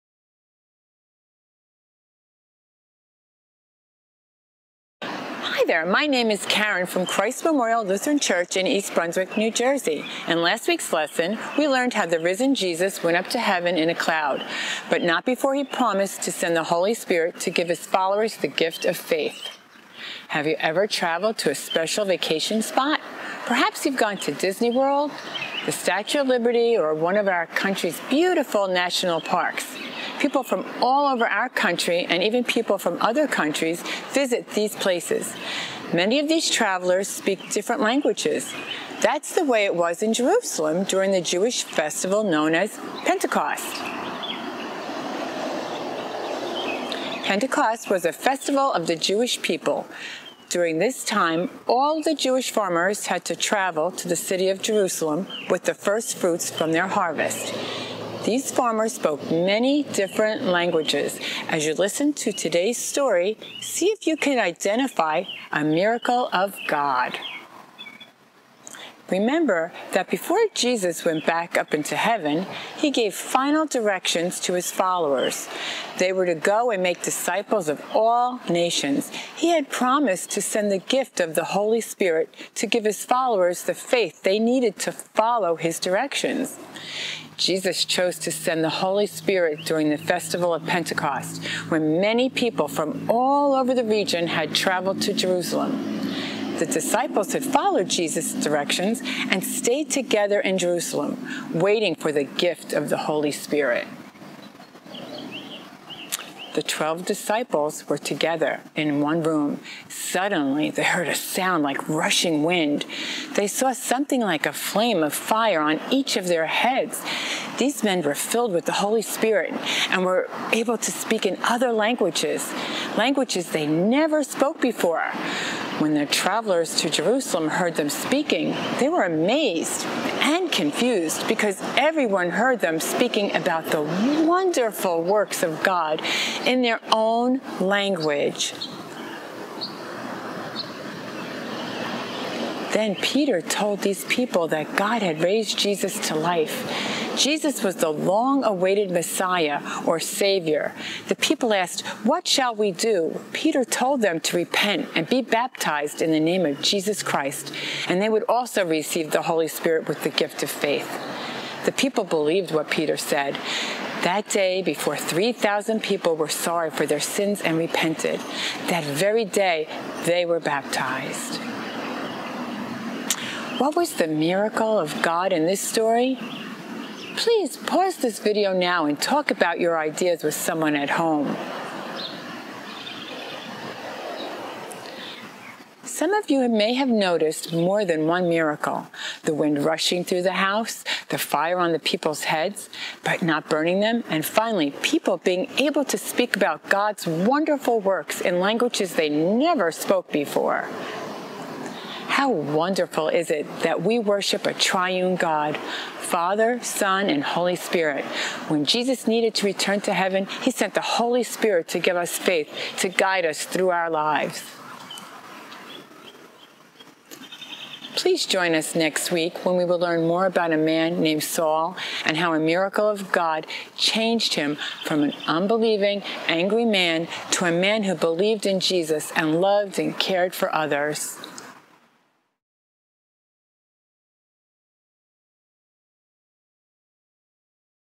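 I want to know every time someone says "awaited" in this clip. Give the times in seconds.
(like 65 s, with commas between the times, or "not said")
148 s.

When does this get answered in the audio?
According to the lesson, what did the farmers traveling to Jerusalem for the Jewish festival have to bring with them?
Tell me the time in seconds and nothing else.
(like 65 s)
55 s.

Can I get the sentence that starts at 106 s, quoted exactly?
The 12 disciples were together in one room.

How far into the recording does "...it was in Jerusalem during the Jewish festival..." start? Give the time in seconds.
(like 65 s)
39 s.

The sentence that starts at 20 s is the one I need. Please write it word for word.
Have you ever traveled to a special vacation spot?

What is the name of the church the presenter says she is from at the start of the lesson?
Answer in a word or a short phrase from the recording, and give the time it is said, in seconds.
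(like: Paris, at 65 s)
Christ Memorial Lutheran Church, at 7 s.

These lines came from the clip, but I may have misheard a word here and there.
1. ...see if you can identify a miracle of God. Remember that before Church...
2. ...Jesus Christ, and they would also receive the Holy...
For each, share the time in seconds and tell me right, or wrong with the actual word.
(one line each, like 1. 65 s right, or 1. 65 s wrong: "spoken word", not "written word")
1. 63 s wrong: "Jesus", not "Church"
2. 156 s right.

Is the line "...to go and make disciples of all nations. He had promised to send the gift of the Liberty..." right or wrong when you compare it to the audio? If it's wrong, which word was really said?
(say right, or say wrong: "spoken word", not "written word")
wrong: "Holy", not "Liberty".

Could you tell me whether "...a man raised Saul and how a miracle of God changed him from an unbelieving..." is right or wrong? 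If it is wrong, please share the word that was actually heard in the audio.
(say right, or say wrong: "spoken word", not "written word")
wrong: "named", not "raised".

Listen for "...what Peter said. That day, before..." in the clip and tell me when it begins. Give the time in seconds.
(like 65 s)
162 s.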